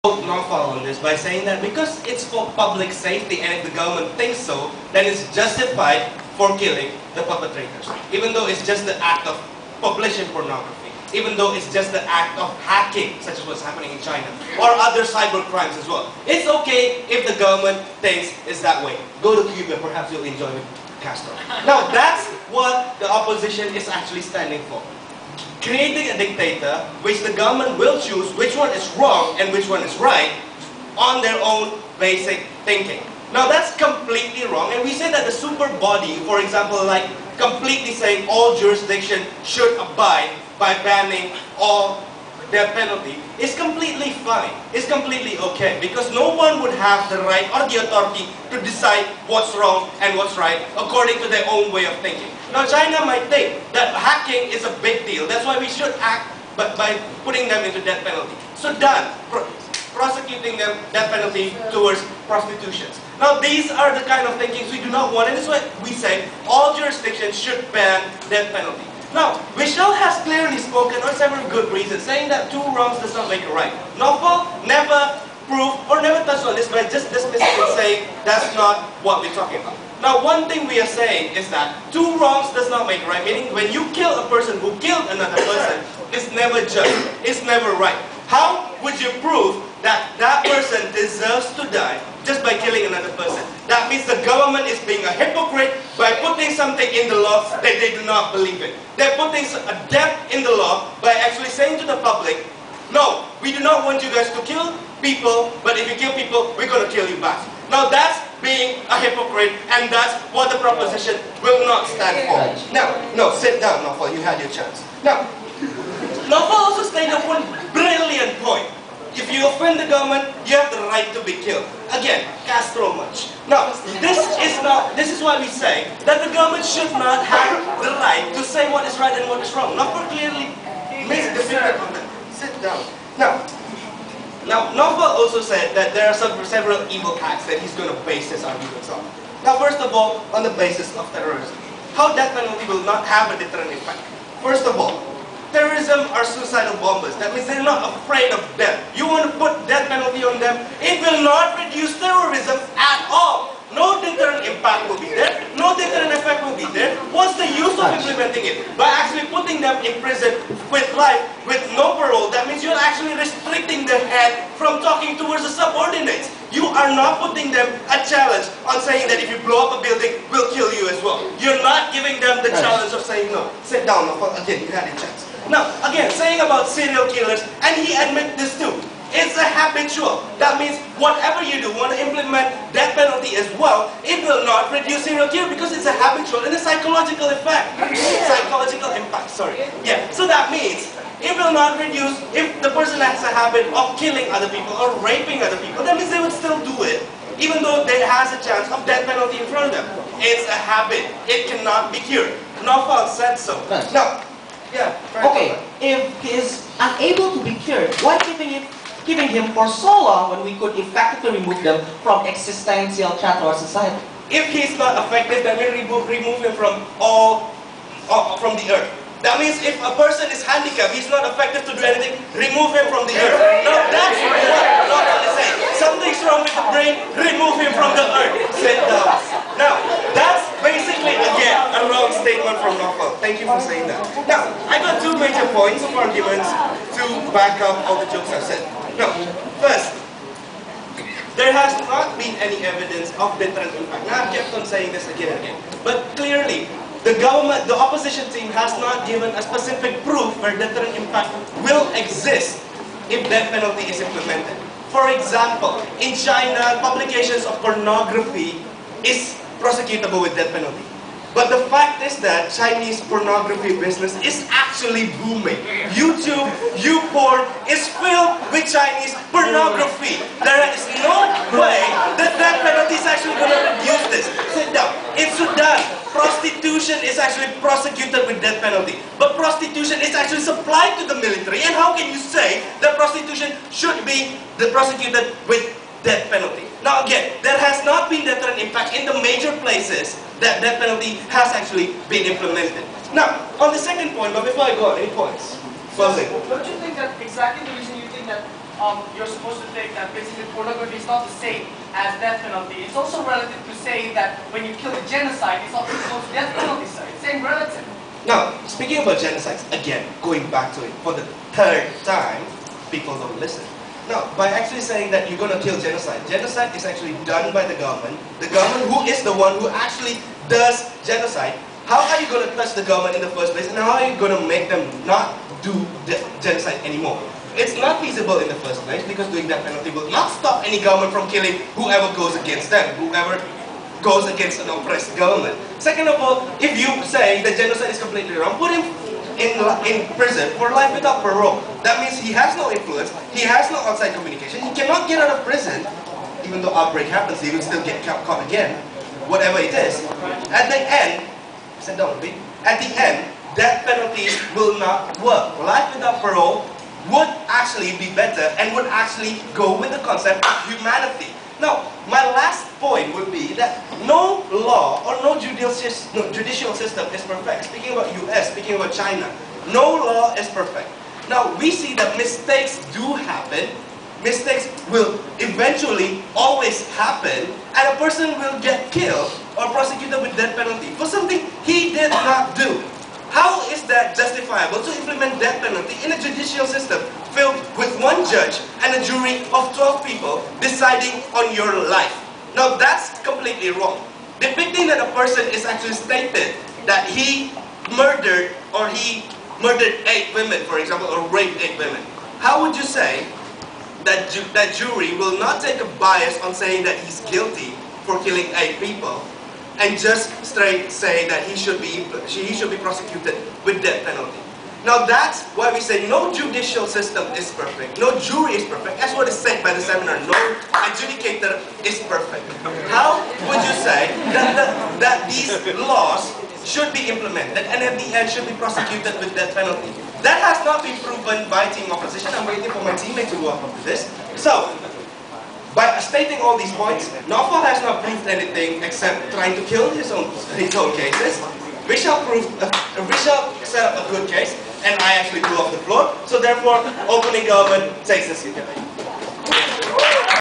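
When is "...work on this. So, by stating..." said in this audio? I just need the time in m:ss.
7:13.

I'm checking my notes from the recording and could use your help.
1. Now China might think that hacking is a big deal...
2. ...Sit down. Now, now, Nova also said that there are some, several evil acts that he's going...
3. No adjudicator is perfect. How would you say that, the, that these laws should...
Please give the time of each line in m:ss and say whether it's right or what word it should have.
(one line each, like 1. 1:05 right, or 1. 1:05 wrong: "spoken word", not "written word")
1. 0:52 right
2. 2:12 right
3. 7:00 right.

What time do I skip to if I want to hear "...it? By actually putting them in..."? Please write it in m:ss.
2:38.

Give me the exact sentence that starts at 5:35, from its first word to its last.
Second of all, if you say that genocide is completely wrong, put in in, in prison for life without parole.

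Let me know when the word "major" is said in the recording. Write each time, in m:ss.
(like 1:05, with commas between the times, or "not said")
3:55, 4:49.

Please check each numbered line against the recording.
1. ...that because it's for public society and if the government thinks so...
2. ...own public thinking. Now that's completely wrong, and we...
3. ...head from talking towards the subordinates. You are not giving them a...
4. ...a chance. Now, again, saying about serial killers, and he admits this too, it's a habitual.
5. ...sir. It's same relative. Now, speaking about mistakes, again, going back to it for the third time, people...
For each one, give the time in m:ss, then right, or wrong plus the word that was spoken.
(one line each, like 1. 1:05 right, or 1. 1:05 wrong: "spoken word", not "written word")
1. 0:01 wrong: "safety", not "society"
2. 0:31 wrong: "basic", not "public"
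3. 2:44 wrong: "putting", not "giving"
4. 2:54 right
5. 5:06 wrong: "genocides", not "mistakes".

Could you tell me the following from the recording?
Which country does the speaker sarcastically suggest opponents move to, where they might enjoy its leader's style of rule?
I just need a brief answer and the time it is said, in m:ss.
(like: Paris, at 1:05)
Cuba, at 0:19.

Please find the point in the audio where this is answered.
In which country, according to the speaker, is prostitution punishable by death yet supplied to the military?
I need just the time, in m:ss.
4:35.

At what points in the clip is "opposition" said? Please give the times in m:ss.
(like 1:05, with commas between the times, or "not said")
0:23, 4:07, 7:11.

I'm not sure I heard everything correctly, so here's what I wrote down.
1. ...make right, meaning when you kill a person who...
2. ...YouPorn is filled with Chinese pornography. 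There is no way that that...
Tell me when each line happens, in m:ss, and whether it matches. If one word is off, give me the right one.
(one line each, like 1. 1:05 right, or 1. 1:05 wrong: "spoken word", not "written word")
1. 1:22 right
2. 4:26 right.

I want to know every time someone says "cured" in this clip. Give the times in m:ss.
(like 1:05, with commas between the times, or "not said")
3:21, 3:27.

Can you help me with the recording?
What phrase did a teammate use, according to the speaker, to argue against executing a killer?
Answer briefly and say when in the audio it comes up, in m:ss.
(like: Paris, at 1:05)
two wrongs does not make a right, at 1:12.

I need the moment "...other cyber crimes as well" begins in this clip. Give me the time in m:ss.
0:14.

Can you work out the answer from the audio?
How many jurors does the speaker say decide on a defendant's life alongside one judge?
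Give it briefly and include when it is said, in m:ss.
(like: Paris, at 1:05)
12, at 6:29.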